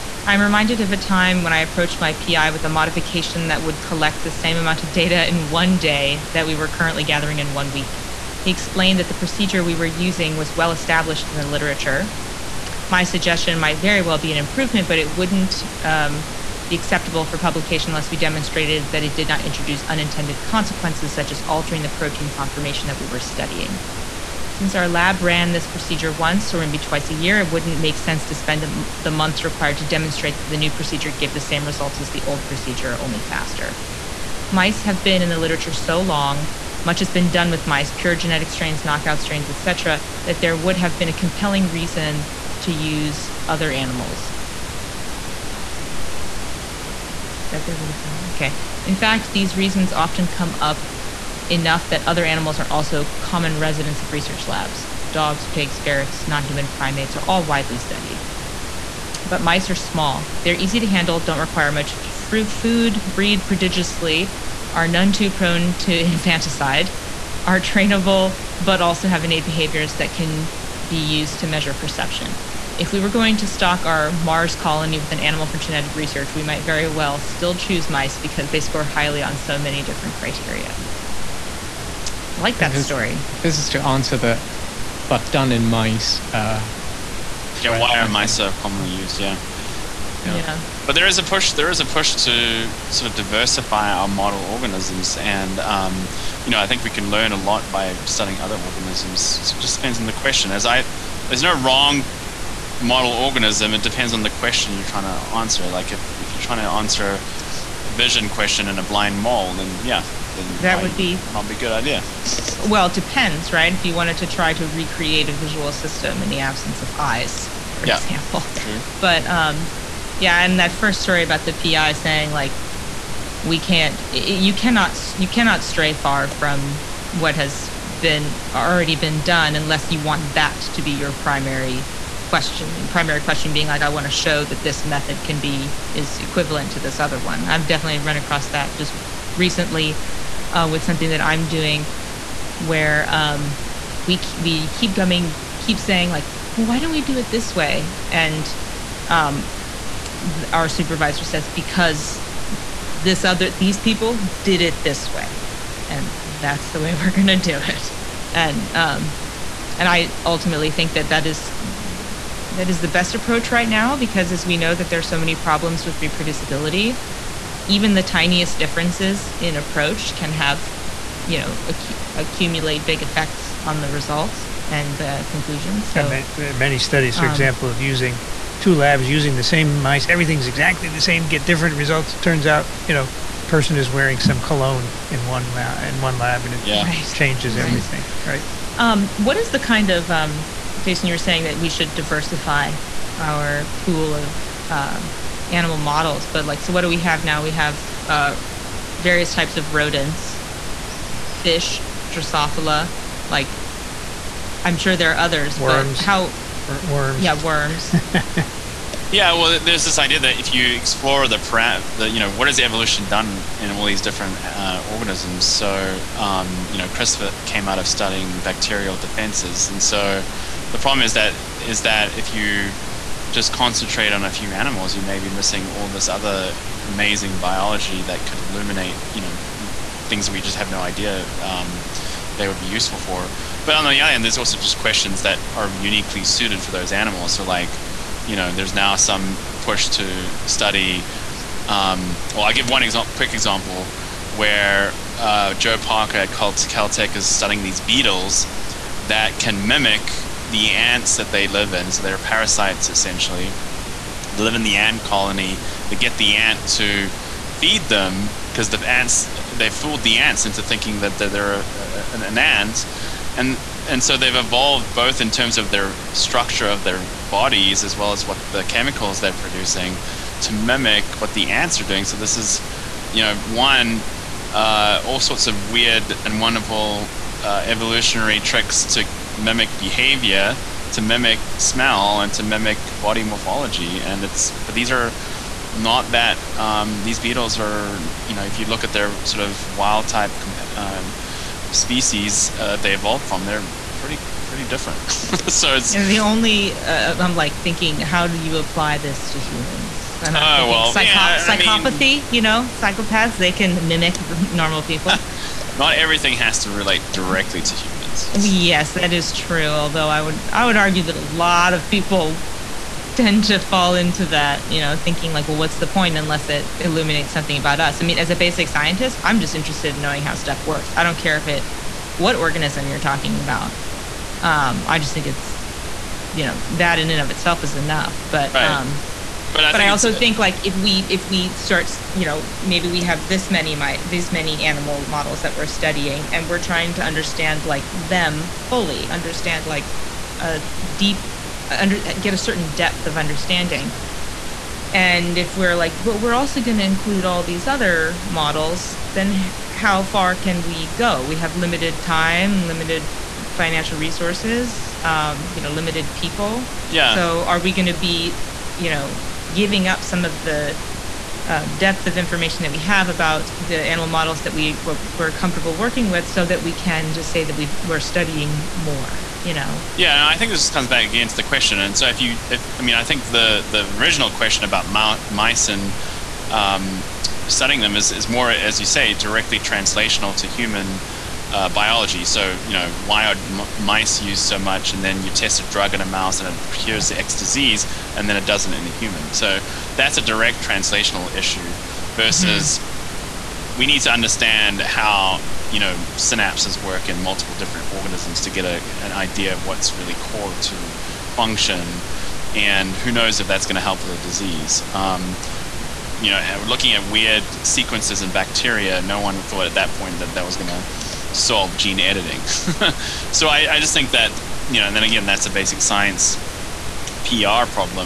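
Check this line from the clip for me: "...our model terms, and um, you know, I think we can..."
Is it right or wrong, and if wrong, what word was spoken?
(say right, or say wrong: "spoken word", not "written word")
wrong: "organisms", not "terms".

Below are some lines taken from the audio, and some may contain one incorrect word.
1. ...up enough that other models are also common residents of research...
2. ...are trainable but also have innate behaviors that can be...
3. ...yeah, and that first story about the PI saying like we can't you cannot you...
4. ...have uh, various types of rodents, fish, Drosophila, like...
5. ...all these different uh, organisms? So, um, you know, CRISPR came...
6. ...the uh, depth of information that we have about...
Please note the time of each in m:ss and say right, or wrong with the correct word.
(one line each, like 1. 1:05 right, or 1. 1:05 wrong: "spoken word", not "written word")
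1. 0:50 wrong: "animals", not "models"
2. 1:07 right
3. 2:00 right
4. 3:17 right
5. 3:33 right
6. 6:00 right.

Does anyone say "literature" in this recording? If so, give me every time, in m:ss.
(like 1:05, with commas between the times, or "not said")
0:11, 0:35.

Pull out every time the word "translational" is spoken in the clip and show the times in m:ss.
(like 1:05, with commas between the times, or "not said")
6:19, 6:30.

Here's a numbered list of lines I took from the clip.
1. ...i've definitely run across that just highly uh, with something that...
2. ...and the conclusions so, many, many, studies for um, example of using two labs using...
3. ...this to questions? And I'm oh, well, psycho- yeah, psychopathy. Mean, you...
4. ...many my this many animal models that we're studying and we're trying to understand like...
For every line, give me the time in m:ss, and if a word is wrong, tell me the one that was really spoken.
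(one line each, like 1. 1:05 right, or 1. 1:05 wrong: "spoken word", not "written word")
1. 2:17 wrong: "recently", not "highly"
2. 2:54 right
3. 4:58 wrong: "humans", not "questions"
4. 5:33 right.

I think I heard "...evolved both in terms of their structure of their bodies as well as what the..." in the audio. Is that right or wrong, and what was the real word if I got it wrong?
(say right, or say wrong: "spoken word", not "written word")
right.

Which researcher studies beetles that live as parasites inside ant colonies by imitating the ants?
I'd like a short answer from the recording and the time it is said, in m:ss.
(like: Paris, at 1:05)
Joe Parker, at 4:05.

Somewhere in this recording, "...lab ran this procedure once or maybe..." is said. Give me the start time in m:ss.
0:24.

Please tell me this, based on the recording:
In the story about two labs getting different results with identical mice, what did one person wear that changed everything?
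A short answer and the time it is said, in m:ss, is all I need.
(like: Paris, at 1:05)
cologne, at 3:04.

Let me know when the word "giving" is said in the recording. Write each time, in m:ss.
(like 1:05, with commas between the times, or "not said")
5:59.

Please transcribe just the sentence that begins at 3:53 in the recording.
But on the other hand, there's also just questions that are uniquely suited for those animals.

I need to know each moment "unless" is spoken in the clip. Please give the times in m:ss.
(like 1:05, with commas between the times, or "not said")
0:17, 2:09, 5:16.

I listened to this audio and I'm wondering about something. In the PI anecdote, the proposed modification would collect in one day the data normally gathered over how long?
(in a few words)
one week.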